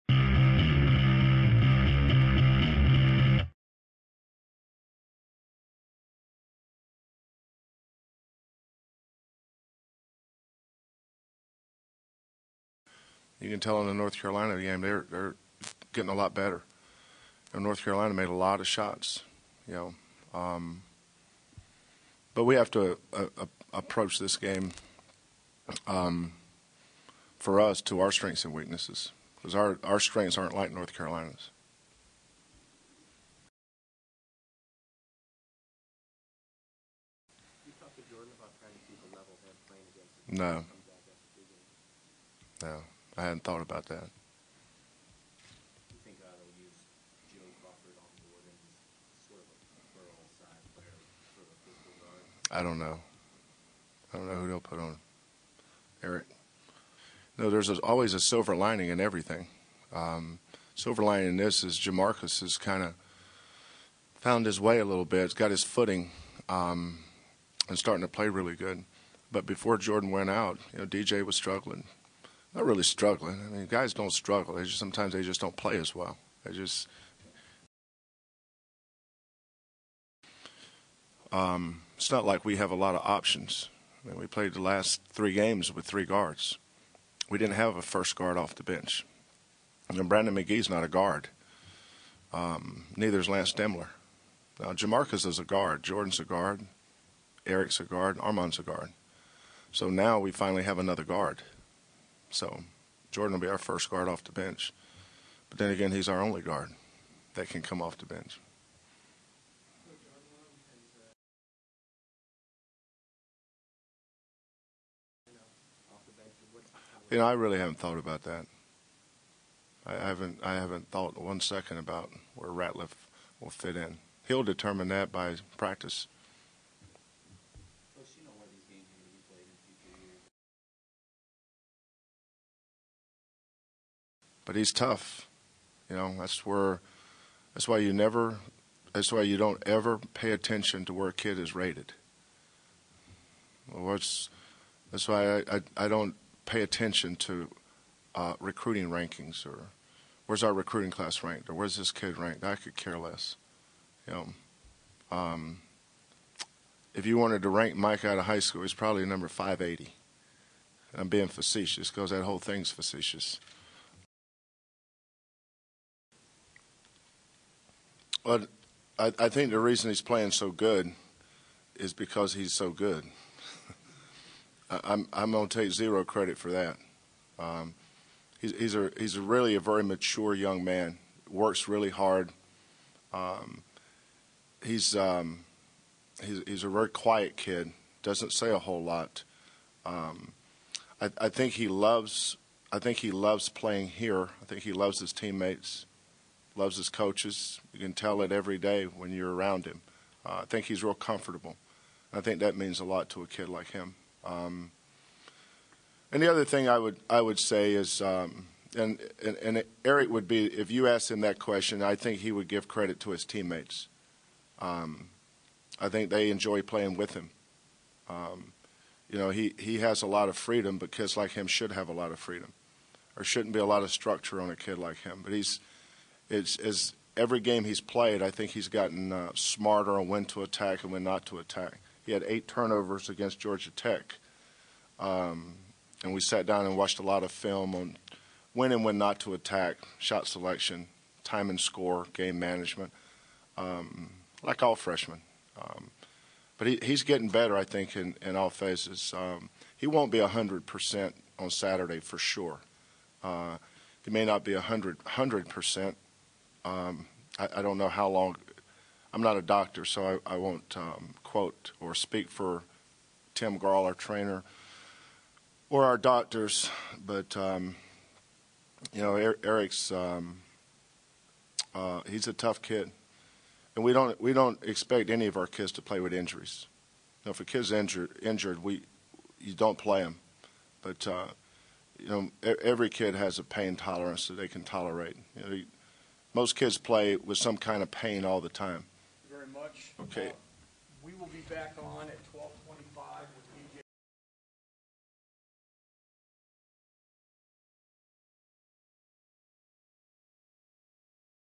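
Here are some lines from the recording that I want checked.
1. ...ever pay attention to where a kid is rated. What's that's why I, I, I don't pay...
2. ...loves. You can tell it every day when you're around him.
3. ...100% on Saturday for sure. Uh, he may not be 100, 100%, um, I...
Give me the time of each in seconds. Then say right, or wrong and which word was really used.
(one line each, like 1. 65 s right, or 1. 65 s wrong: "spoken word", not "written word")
1. 139 s right
2. 196 s wrong: "coaches", not "loves"
3. 250 s right.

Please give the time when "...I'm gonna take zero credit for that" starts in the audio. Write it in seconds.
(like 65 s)
175 s.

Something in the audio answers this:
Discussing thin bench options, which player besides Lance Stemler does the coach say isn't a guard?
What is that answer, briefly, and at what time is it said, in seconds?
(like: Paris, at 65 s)
Brandon McGee, at 90 s.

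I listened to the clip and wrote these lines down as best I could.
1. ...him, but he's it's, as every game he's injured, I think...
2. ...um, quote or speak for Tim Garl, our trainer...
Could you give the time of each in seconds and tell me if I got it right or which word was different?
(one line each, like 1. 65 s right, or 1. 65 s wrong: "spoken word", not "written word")
1. 225 s wrong: "played", not "injured"
2. 260 s right.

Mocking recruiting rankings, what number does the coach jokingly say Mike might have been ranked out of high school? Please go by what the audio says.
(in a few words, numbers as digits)
580.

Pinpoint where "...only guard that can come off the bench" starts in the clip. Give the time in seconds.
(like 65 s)
106 s.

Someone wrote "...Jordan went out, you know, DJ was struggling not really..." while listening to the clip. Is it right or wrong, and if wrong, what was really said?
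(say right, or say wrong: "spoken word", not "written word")
right.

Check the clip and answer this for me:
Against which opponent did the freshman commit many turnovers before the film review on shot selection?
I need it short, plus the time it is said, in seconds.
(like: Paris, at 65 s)
Georgia Tech, at 233 s.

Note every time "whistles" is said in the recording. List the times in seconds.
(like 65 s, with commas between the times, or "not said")
not said.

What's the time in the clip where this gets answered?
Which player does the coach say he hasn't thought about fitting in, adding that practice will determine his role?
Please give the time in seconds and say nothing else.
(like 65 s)
122 s.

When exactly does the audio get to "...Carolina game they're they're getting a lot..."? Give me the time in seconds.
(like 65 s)
14 s.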